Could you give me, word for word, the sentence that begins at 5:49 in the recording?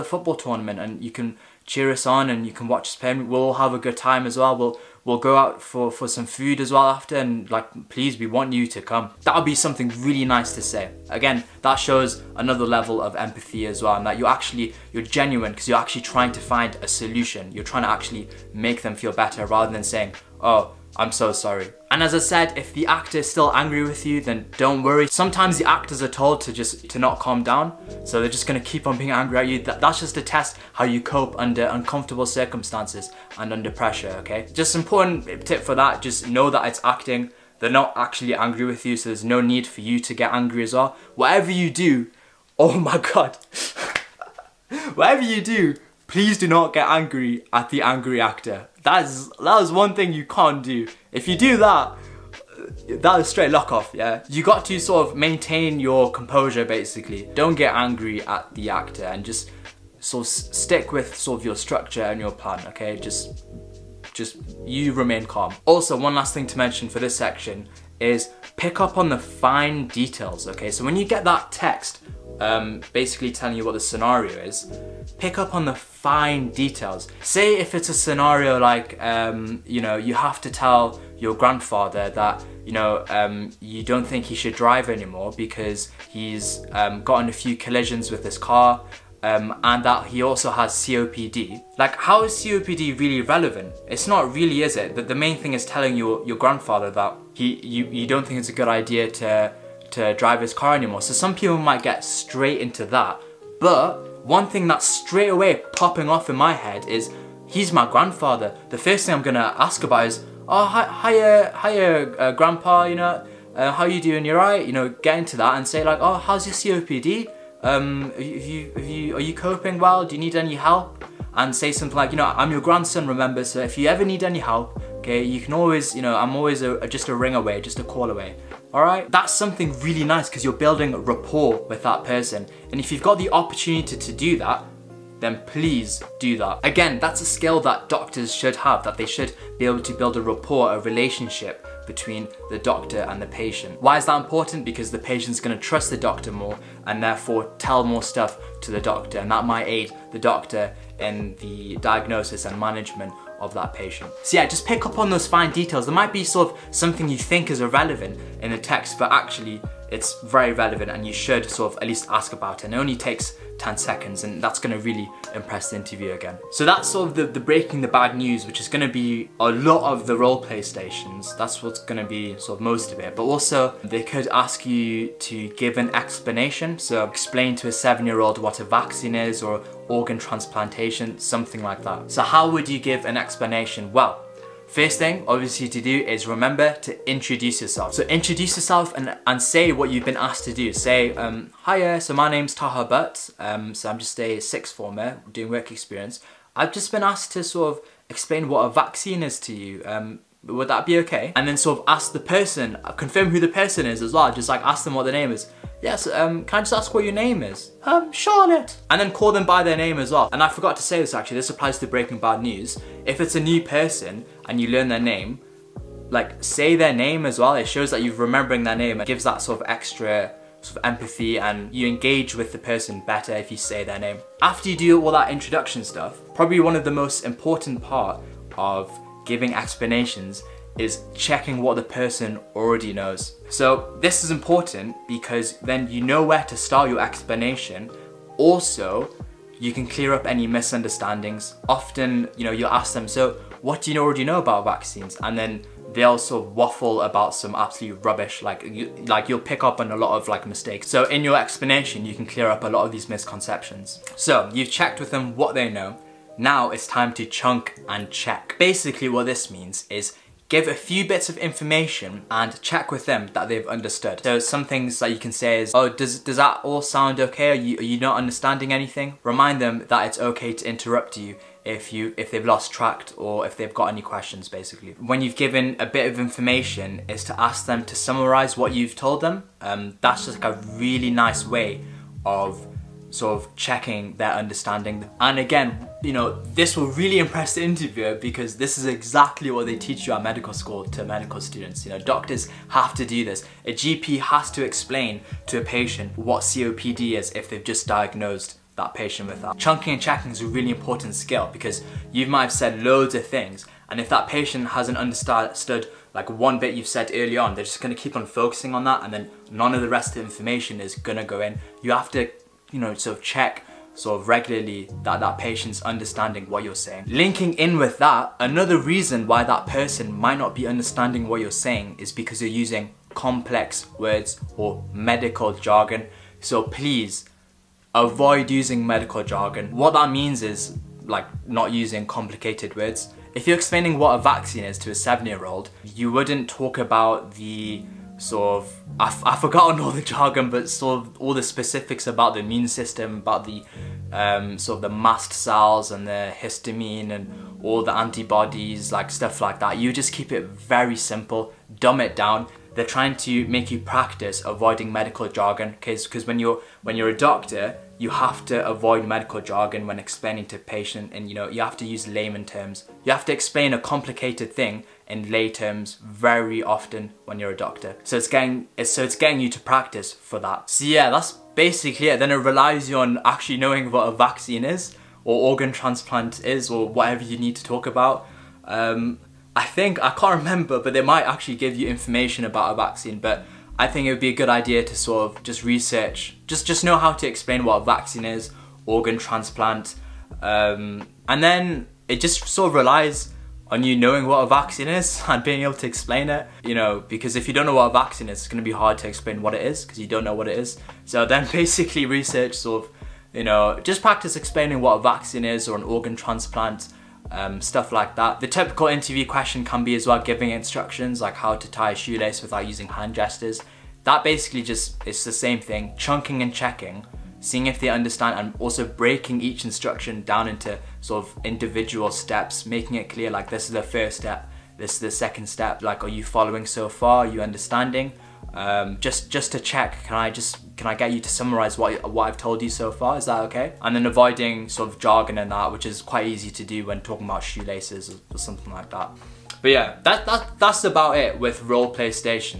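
You just keep it very simple, dumb it down.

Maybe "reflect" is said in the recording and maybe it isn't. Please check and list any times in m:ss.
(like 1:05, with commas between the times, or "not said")
not said.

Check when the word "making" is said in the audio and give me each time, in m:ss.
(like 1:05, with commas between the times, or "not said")
7:02.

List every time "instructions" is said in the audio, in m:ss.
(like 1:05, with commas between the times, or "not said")
6:50, 6:59.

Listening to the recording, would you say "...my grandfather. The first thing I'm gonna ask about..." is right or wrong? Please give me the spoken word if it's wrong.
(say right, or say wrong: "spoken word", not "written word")
right.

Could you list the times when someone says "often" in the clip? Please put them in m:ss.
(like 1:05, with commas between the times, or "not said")
4:01, 6:06.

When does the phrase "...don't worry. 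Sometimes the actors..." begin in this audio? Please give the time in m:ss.
0:24.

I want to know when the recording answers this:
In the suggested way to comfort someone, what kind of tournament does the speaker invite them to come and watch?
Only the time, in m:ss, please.
0:00.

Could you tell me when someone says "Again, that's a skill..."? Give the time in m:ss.
2:16.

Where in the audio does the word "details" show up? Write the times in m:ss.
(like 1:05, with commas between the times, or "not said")
1:09, 1:16, 2:35.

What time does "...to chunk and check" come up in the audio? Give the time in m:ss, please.
4:17.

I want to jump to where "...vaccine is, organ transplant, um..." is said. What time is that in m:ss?
6:27.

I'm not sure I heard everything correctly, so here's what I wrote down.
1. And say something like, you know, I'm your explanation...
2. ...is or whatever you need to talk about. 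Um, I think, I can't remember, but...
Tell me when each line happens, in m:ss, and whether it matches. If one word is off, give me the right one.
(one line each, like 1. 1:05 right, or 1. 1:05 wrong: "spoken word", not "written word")
1. 2:01 wrong: "grandson", not "explanation"
2. 6:16 right.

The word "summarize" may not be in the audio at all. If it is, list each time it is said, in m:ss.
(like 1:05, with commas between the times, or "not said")
4:37, 7:11.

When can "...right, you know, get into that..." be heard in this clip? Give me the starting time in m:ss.
1:54.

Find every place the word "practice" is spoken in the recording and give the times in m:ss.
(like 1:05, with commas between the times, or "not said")
5:53, 6:09, 6:44.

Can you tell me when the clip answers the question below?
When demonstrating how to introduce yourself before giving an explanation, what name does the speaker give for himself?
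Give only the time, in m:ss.
3:12.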